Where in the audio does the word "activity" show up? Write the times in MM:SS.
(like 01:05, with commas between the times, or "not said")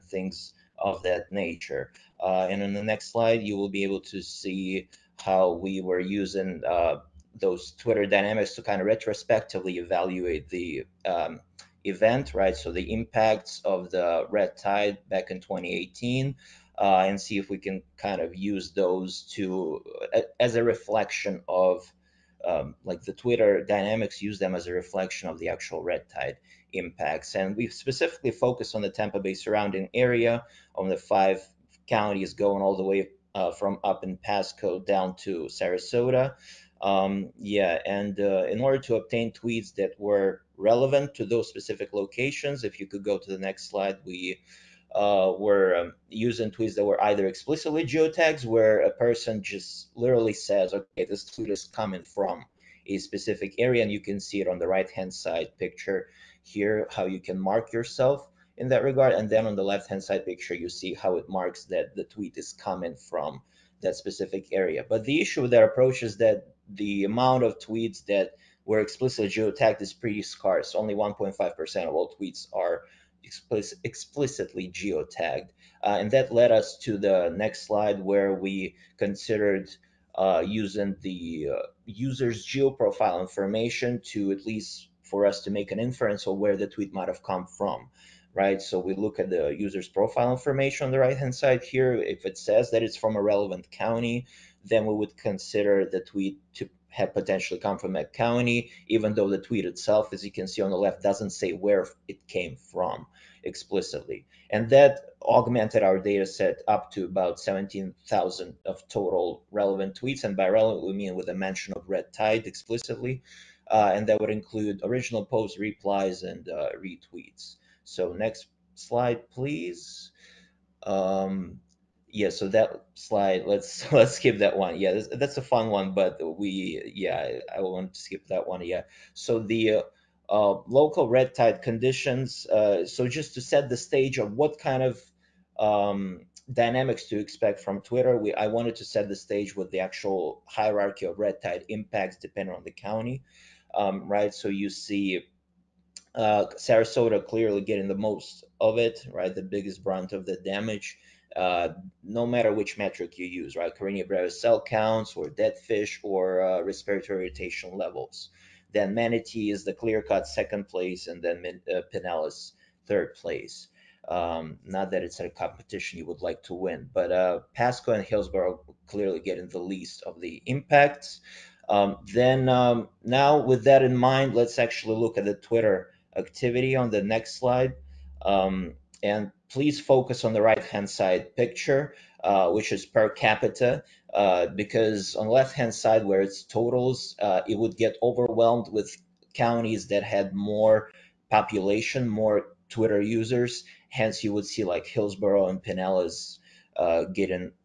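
02:56.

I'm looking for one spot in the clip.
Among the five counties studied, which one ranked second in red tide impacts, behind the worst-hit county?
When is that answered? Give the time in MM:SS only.
02:38.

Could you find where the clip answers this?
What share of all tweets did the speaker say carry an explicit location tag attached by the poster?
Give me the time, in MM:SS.
01:10.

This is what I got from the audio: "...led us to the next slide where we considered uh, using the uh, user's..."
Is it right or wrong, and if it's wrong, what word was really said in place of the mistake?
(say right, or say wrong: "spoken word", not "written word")
right.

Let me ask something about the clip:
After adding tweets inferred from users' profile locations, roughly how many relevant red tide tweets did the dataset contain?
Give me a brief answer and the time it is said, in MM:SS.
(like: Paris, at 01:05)
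17,000, at 01:47.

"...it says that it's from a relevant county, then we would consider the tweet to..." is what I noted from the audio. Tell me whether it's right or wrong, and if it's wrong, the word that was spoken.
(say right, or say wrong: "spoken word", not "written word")
right.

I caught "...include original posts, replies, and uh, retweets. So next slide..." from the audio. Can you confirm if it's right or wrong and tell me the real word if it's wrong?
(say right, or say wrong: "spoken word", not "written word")
right.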